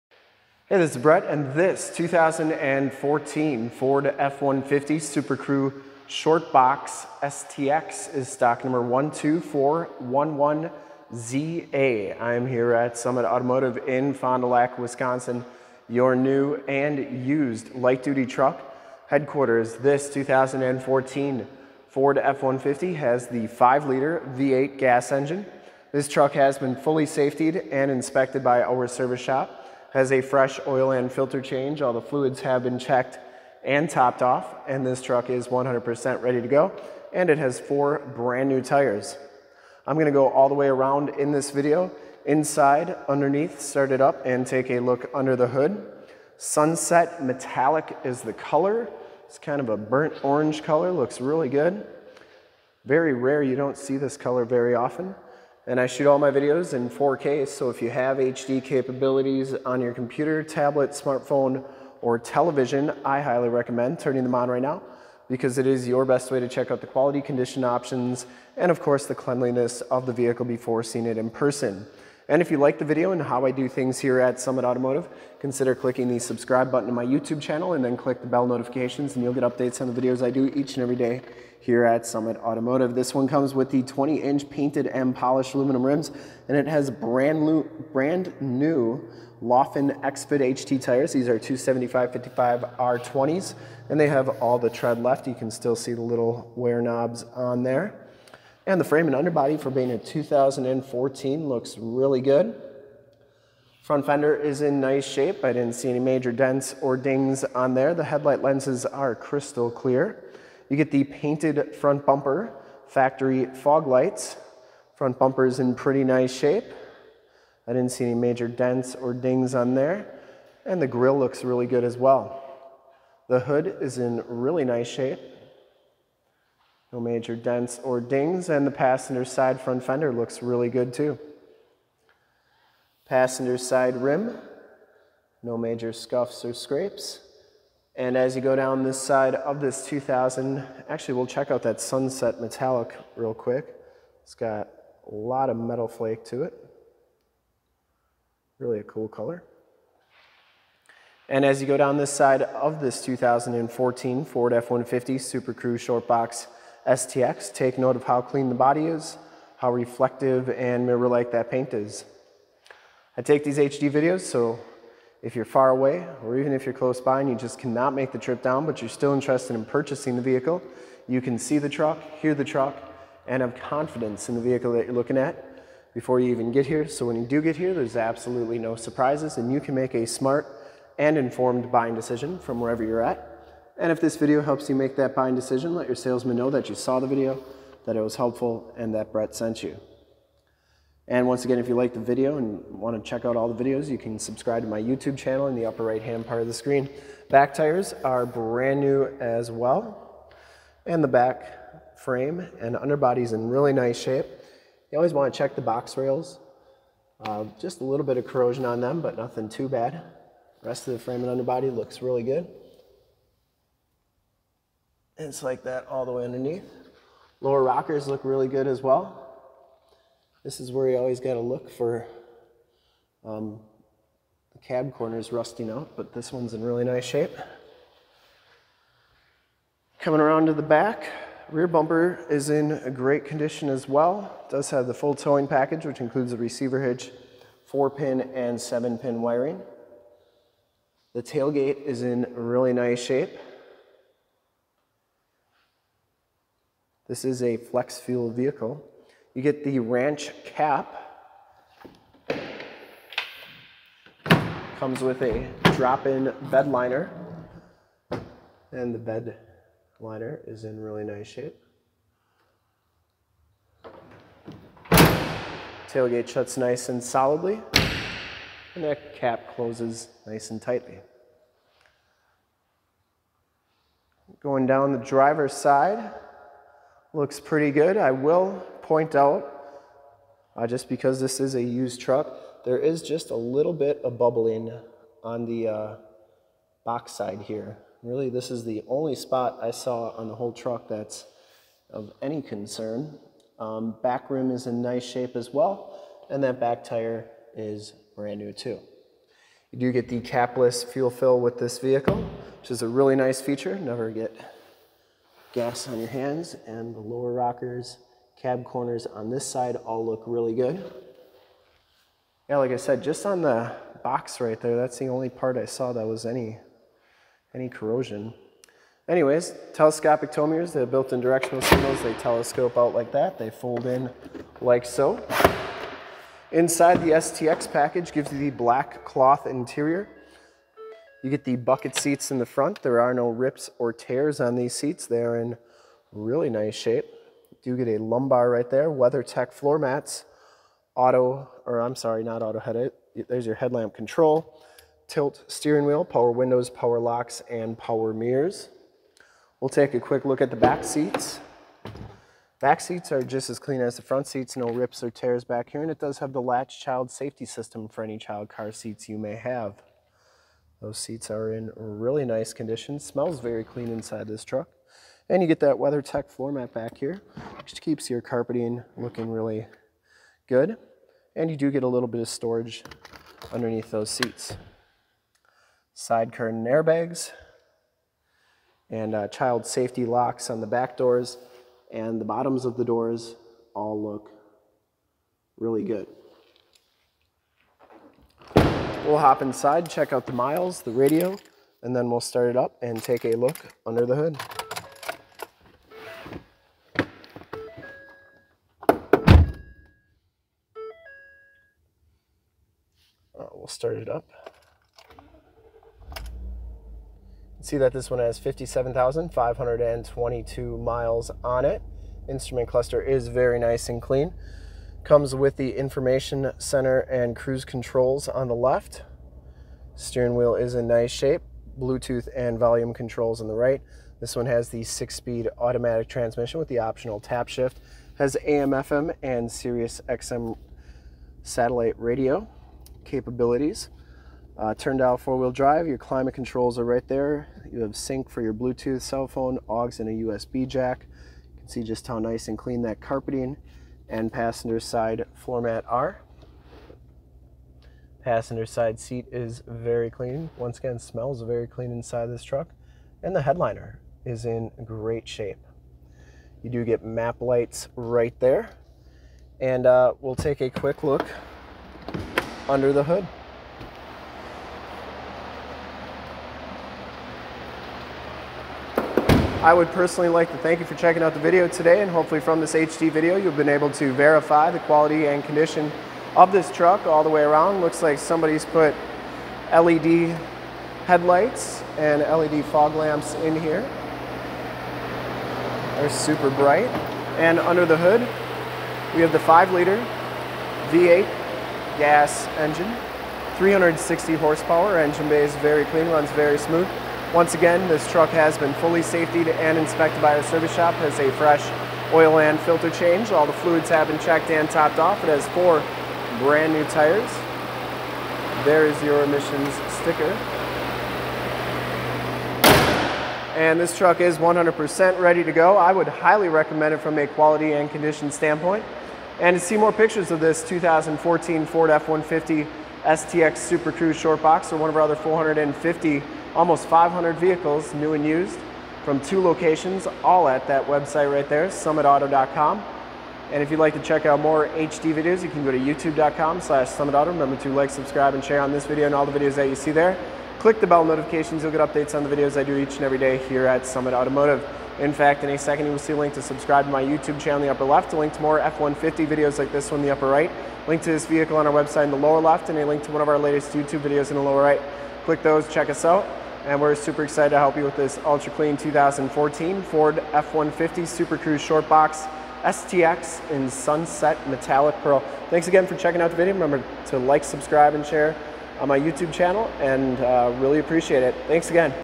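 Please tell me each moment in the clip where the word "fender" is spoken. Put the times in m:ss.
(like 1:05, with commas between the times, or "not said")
1:44, 2:09.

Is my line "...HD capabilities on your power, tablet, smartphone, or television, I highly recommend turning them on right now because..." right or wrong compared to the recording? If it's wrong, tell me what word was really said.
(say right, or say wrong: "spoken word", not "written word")
wrong: "computer", not "power".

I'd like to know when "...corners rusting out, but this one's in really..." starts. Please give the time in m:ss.
3:44.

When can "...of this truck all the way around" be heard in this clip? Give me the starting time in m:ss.
7:56.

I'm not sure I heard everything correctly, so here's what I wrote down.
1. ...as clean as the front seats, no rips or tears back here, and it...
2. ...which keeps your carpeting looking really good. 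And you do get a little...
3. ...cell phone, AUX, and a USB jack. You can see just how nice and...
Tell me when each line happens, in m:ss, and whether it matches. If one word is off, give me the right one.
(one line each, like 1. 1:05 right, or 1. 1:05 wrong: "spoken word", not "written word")
1. 5:53 right
2. 6:07 right
3. 7:19 right.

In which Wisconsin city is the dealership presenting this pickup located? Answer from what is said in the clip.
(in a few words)
Fond du Lac.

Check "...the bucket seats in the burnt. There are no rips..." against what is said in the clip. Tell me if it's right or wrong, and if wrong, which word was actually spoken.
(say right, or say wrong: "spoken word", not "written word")
wrong: "front", not "burnt".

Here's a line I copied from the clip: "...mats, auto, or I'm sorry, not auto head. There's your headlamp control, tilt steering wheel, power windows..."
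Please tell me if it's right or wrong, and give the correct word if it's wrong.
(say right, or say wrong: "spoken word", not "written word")
right.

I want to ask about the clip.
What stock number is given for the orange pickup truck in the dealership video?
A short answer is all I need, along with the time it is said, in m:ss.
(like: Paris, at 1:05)
12411ZA, at 0:08.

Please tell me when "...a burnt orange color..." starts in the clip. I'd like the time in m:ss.
0:49.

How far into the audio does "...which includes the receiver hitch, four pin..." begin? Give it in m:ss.
3:55.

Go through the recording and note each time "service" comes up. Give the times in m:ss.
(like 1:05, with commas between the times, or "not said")
0:28, 8:20.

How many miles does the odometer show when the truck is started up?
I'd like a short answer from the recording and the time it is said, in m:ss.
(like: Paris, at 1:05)
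57,522, at 6:48.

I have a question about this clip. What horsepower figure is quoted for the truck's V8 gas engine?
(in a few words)
360.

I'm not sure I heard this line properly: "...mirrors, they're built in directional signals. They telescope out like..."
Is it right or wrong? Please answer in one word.
right.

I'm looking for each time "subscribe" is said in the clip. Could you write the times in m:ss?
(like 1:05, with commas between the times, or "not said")
1:16, 3:14, 8:57, 9:06, 9:27.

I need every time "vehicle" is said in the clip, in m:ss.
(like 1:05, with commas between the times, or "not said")
1:10, 2:50, 2:54, 4:08, 5:01, 8:47, 9:11.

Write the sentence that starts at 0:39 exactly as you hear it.
I'm gonna go all the way around in this video, inside, underneath, start it up, and take a look under the hood.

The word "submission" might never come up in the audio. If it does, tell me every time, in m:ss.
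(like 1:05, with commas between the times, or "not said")
not said.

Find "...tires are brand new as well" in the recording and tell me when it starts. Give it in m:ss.
3:17.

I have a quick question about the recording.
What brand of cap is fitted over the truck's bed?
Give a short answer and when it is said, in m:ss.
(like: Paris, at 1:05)
Ranch, at 4:09.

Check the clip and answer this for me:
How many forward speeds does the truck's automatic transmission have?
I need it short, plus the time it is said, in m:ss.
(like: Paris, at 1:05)
6, at 7:04.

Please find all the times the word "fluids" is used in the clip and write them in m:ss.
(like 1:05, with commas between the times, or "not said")
0:32, 8:23.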